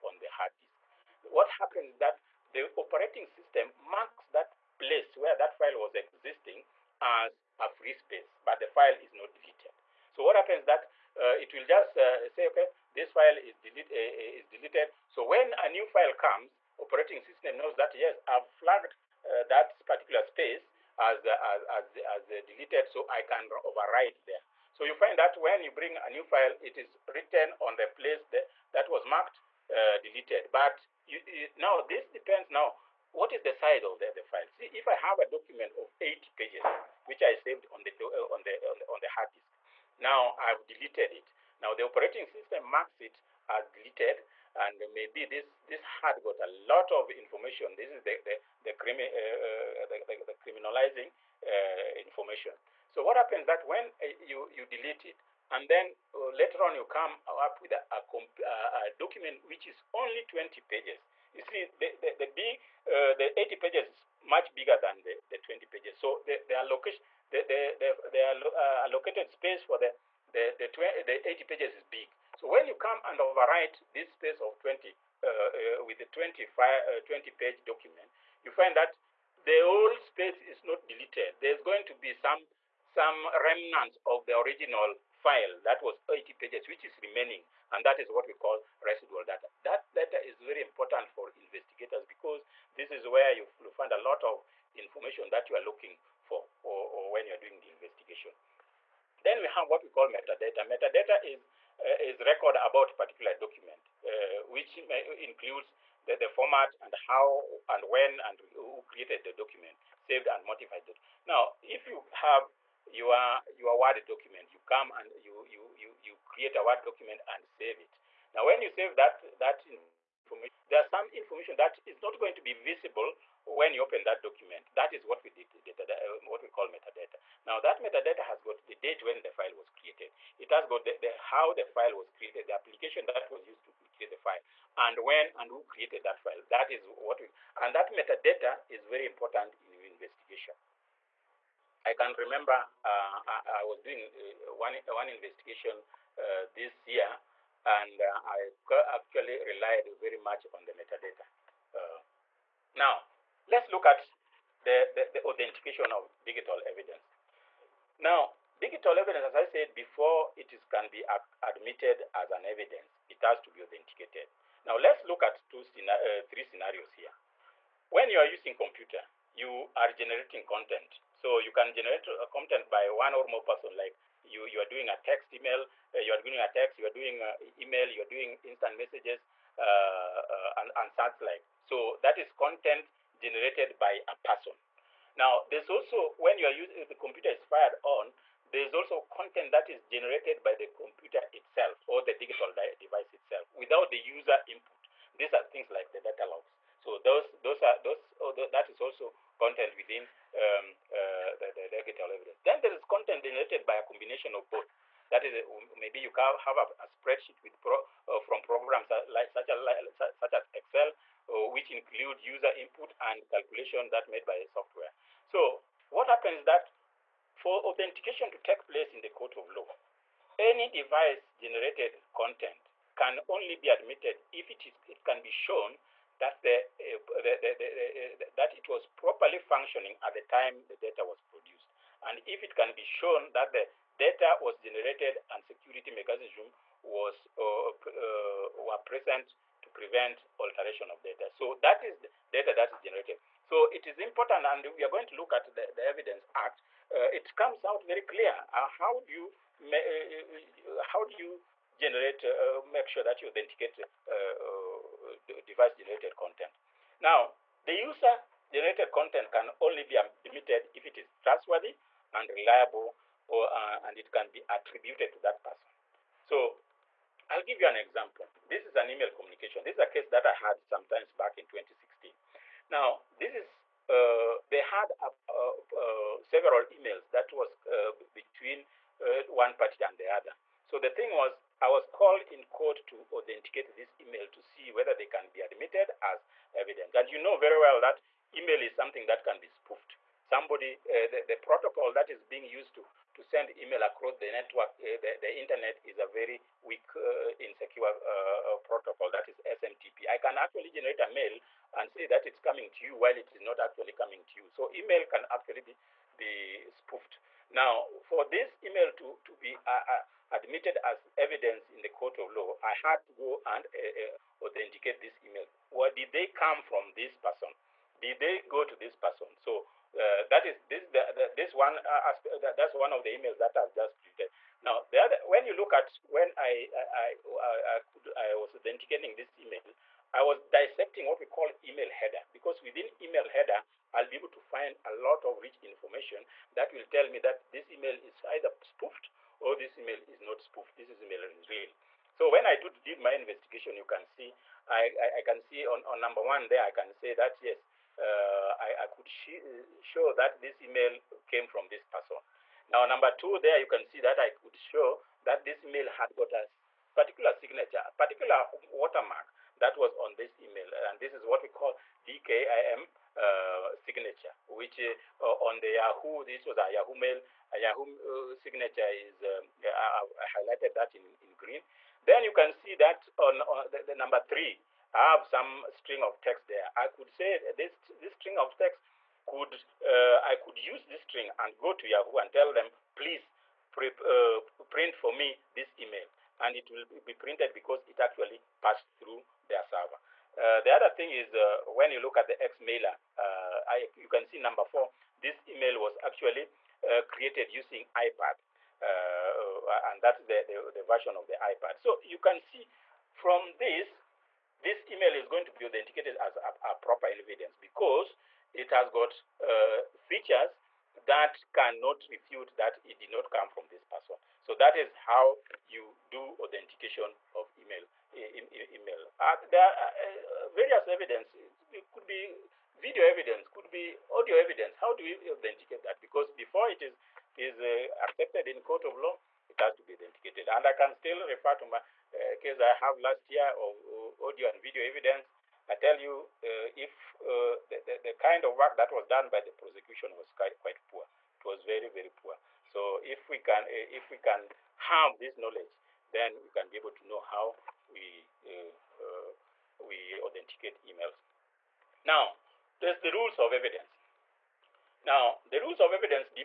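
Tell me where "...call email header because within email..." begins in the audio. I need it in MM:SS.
05:31.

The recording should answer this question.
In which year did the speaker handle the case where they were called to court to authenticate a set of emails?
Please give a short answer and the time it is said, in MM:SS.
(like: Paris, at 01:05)
2016, at 04:31.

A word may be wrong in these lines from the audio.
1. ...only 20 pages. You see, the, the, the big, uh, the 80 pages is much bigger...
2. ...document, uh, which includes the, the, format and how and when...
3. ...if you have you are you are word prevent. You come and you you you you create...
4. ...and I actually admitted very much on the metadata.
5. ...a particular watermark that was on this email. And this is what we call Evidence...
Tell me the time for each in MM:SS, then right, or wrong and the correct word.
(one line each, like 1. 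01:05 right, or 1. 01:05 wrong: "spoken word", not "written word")
1. 00:59 right
2. 01:43 right
3. 01:51 wrong: "document", not "prevent"
4. 02:27 wrong: "relied", not "admitted"
5. 05:57 wrong: "DKIM", not "Evidence".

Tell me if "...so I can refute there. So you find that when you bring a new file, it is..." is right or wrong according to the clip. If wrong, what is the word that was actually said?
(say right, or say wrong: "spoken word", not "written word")
wrong: "overwrite", not "refute".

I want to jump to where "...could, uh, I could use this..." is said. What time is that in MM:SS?
06:19.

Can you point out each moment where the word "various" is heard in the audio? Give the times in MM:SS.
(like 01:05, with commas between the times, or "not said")
07:00.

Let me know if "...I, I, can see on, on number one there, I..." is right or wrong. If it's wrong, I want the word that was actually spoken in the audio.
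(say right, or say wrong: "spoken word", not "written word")
right.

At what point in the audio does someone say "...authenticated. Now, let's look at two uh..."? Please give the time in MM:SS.
02:43.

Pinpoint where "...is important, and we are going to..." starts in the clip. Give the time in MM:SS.
04:03.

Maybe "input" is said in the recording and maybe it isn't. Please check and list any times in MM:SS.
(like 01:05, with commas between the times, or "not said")
03:14, 03:32.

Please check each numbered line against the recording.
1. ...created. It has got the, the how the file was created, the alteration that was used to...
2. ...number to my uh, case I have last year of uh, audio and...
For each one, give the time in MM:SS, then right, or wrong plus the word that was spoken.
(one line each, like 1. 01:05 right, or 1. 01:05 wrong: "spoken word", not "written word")
1. 02:09 wrong: "application", not "alteration"
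2. 07:11 wrong: "refer", not "number".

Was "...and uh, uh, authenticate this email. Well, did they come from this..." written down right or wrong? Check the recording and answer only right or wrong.
right.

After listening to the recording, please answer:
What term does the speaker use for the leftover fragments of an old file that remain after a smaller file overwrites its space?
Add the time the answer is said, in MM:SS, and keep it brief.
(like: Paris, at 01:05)
residual data, at 01:28.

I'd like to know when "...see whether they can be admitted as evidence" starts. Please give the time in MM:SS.
04:44.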